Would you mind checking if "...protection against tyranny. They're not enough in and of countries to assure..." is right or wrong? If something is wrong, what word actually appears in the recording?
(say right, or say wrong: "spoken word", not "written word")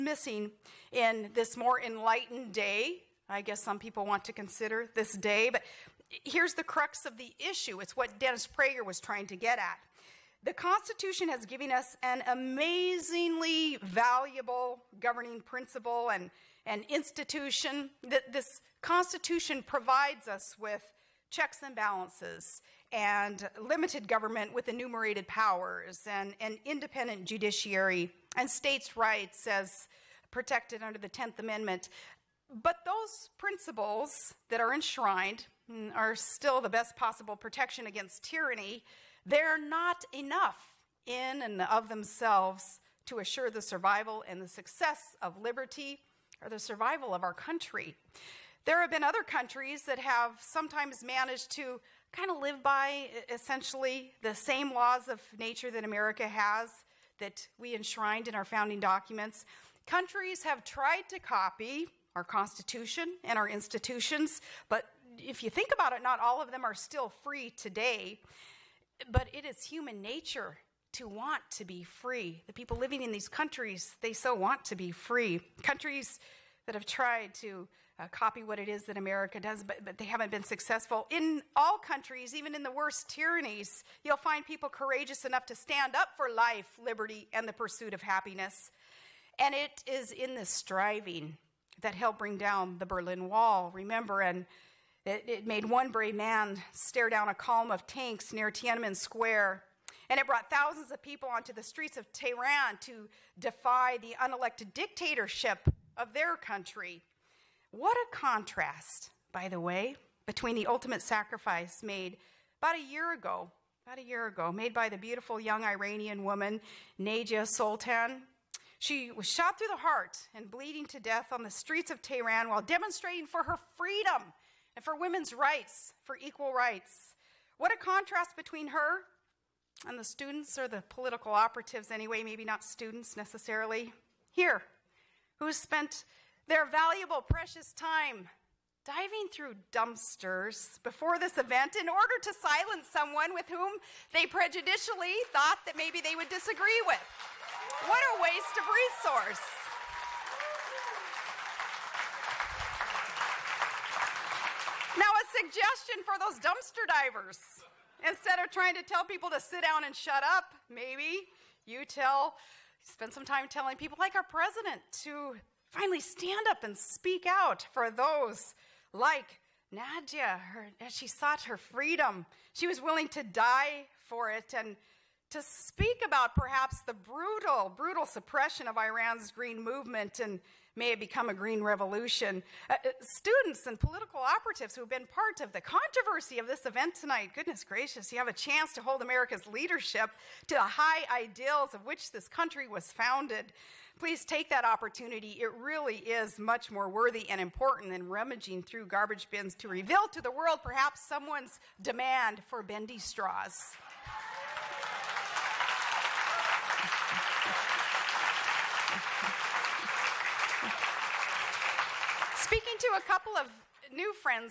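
wrong: "themselves", not "countries".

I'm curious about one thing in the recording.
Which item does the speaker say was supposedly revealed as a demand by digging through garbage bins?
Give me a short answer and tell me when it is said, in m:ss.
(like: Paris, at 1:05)
bendy straws, at 3:22.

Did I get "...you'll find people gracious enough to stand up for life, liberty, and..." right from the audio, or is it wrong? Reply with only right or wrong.
wrong.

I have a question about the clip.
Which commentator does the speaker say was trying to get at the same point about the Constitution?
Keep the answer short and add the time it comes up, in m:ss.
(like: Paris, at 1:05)
Dennis Prager, at 0:08.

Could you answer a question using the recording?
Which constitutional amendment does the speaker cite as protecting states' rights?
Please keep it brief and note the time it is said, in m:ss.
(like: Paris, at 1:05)
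10th Amendment, at 0:30.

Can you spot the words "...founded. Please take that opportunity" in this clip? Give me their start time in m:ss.
3:12.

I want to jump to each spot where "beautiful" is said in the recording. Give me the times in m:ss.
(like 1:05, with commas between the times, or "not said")
1:54.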